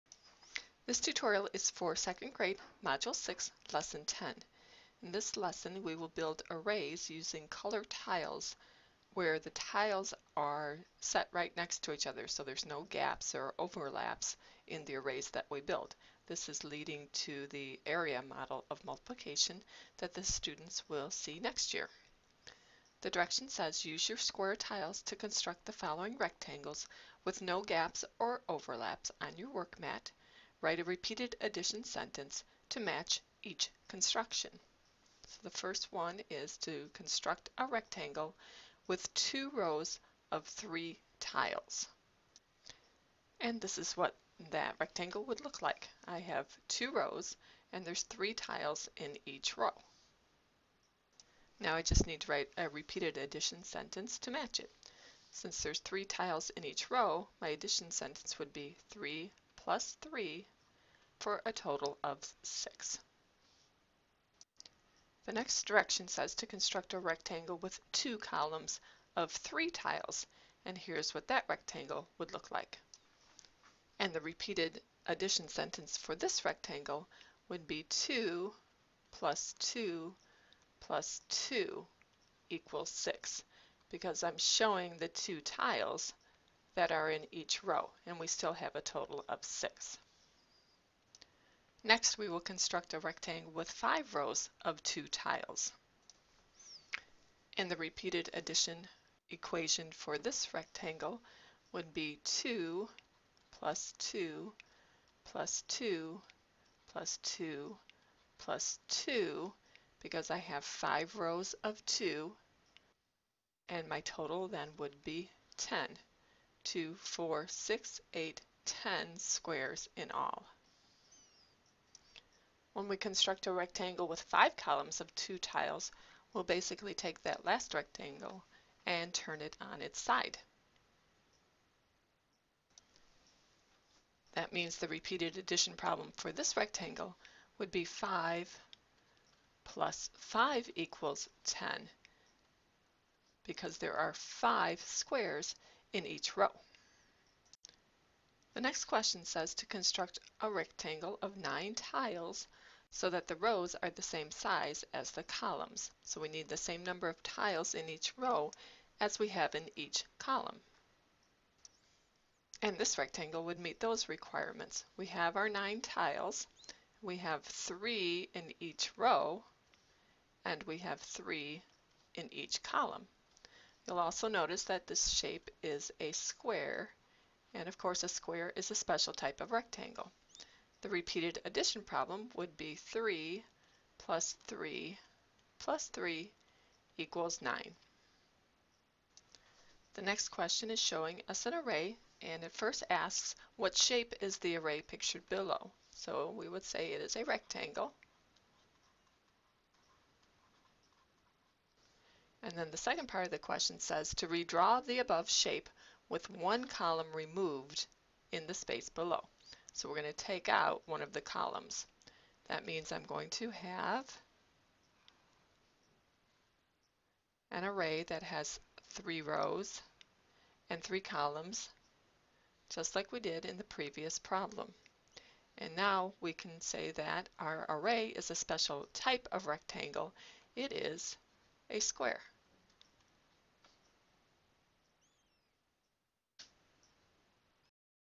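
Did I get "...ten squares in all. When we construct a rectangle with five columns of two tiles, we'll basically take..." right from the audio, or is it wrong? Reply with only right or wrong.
right.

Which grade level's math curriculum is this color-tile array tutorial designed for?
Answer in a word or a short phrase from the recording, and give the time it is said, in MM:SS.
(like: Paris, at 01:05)
second grade, at 00:01.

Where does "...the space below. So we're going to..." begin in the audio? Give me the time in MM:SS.
03:28.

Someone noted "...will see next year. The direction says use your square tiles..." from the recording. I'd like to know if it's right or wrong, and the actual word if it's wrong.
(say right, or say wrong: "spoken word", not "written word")
right.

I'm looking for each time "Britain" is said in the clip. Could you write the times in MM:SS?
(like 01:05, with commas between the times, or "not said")
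not said.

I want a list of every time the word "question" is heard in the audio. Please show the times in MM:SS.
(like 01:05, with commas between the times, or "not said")
02:28, 03:10, 03:23.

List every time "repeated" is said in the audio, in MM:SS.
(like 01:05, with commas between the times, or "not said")
00:30, 00:52, 01:14, 01:37, 02:14, 03:00.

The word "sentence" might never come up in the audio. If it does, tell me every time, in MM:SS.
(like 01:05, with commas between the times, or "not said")
00:31, 00:53, 00:57, 01:15.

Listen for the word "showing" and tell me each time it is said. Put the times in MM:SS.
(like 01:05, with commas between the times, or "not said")
01:24, 03:10.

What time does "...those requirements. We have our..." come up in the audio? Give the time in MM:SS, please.
02:43.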